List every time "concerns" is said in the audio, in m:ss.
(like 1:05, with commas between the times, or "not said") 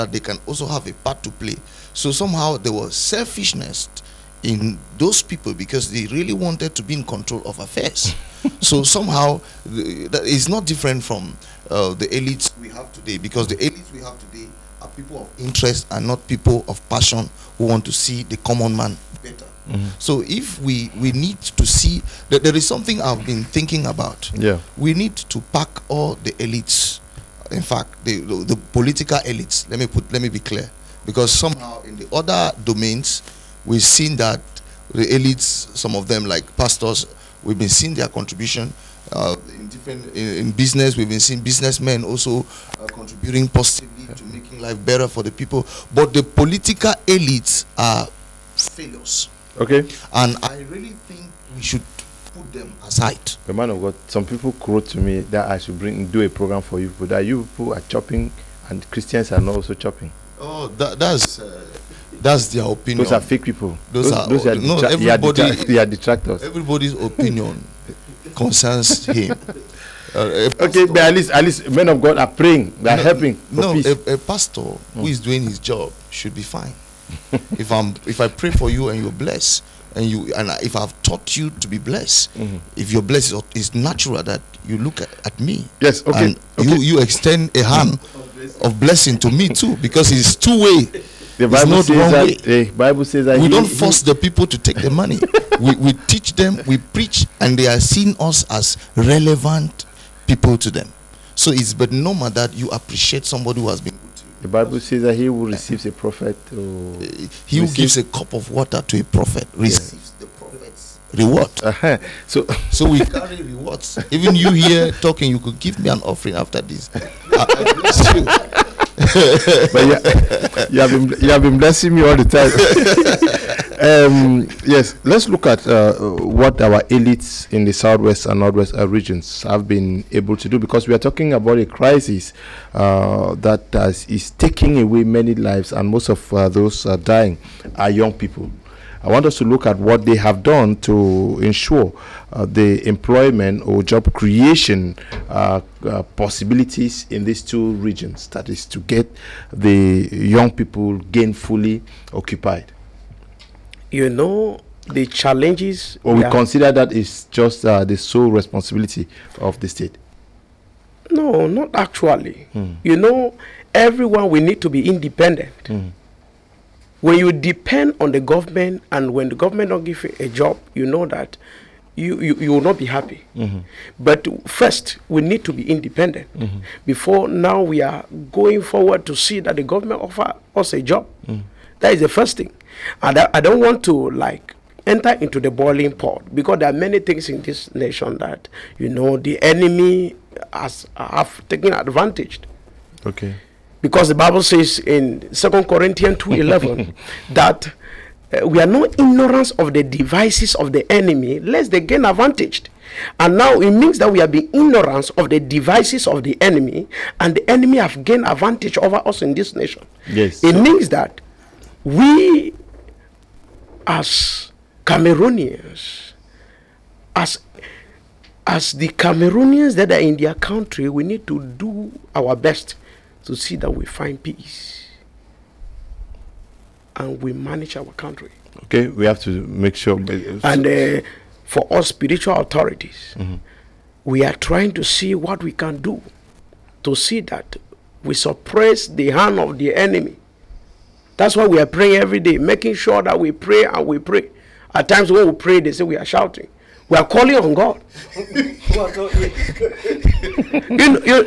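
1:08.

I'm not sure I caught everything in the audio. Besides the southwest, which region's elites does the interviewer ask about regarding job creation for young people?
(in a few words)
Northwest.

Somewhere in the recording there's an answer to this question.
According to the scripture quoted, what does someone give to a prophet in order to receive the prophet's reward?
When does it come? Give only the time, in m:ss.
1:48.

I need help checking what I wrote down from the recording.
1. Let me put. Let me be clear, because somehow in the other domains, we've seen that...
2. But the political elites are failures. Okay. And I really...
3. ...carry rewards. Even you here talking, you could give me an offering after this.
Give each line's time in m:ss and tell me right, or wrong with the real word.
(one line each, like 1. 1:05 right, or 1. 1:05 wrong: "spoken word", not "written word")
1. 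0:29 right
2. 0:45 right
3. 1:53 right.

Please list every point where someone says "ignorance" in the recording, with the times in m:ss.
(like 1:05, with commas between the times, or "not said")
3:18, 3:24.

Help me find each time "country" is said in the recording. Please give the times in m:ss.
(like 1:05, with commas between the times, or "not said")
3:40, 3:47.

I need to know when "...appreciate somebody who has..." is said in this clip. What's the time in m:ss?
1:42.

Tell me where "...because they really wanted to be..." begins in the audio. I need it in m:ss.
0:05.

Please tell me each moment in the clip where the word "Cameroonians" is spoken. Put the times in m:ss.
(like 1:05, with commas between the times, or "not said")
3:34, 3:38.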